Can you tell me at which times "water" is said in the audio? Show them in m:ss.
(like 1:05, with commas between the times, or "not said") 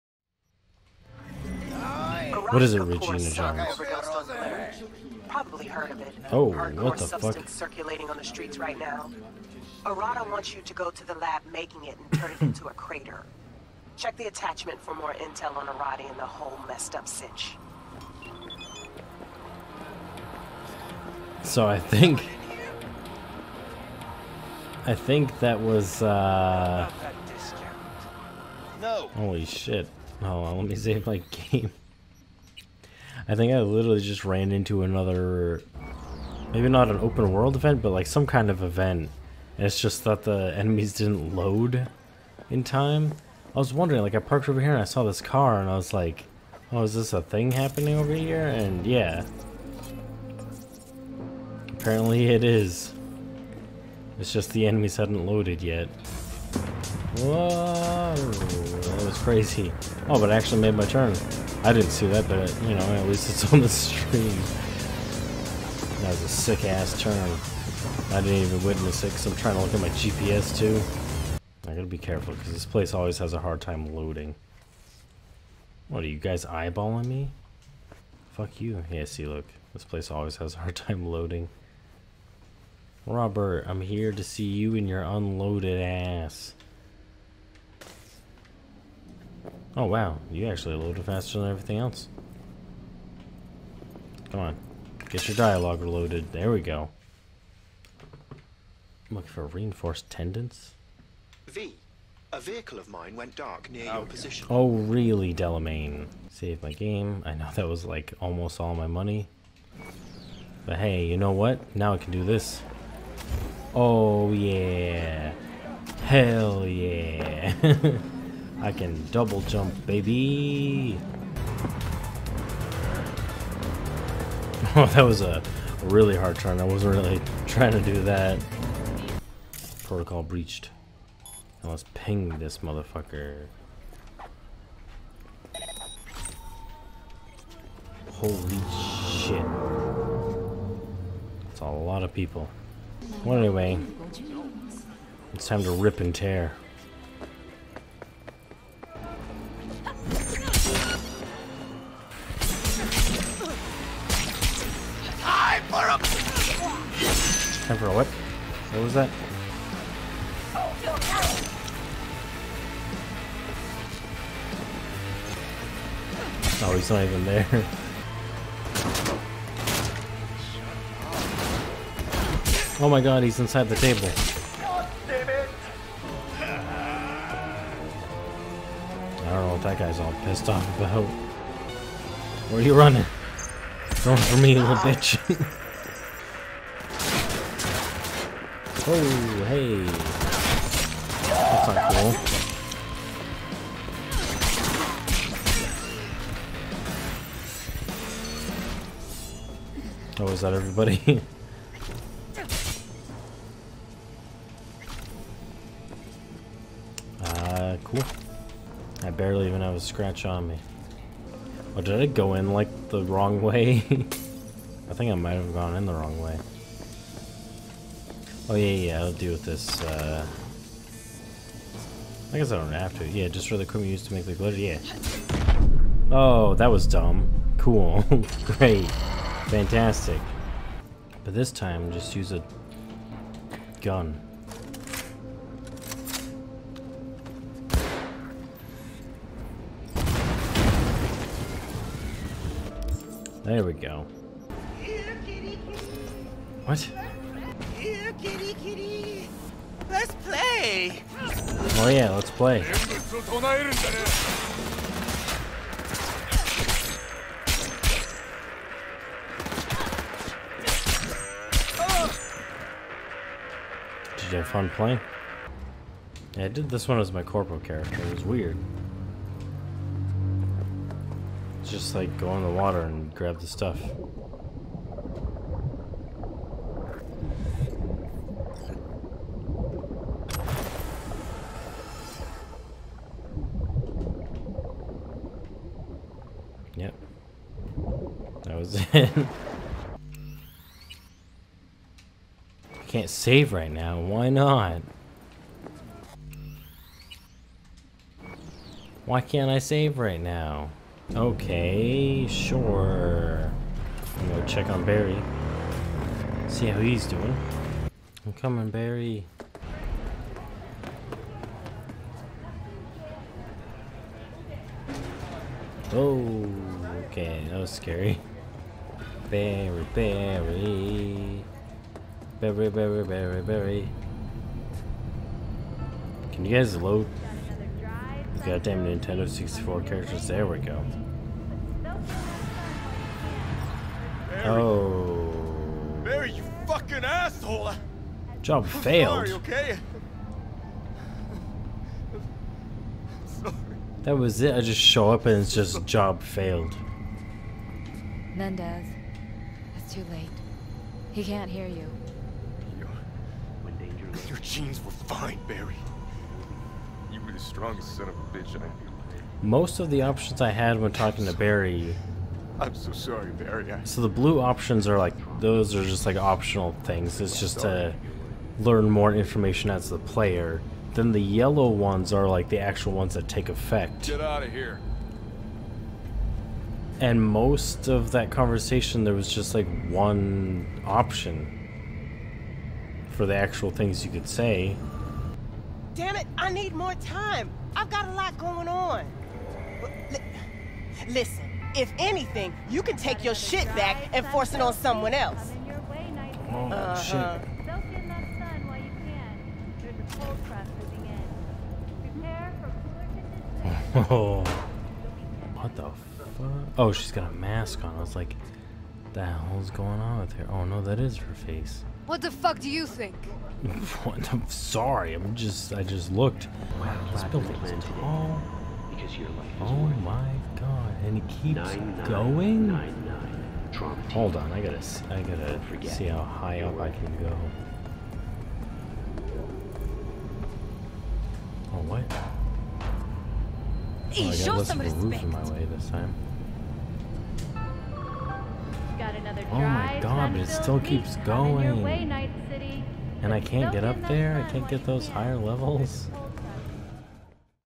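4:32.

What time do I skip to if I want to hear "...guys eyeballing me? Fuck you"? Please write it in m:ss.
1:16.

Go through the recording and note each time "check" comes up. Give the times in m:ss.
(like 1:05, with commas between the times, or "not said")
0:13, 5:04.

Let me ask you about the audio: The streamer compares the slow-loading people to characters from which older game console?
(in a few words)
Nintendo 64.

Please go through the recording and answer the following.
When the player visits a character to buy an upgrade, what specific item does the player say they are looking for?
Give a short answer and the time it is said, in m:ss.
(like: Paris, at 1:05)
reinforced tendons, at 1:39.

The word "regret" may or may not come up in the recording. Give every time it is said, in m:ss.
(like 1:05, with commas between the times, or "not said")
not said.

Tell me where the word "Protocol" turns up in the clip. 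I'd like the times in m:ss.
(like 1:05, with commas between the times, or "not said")
2:09.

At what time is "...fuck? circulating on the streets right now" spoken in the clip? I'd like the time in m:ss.
0:07.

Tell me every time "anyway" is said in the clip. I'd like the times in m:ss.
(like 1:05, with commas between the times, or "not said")
2:23.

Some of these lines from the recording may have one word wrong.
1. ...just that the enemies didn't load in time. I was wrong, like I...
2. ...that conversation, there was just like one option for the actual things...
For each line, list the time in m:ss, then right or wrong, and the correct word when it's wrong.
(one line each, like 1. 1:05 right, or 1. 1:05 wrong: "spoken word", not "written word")
1. 0:39 wrong: "wondering", not "wrong"
2. 6:18 right.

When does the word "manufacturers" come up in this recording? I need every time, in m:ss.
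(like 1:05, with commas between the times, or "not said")
not said.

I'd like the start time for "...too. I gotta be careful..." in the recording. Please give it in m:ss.
1:10.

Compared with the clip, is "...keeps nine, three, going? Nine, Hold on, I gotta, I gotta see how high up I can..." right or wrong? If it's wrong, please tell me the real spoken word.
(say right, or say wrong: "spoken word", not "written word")
wrong: "nine", not "three".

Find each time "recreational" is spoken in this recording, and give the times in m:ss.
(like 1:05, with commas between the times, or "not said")
not said.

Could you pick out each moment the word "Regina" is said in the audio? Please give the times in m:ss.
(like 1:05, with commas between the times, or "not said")
0:02.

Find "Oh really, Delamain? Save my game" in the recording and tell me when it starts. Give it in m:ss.
1:44.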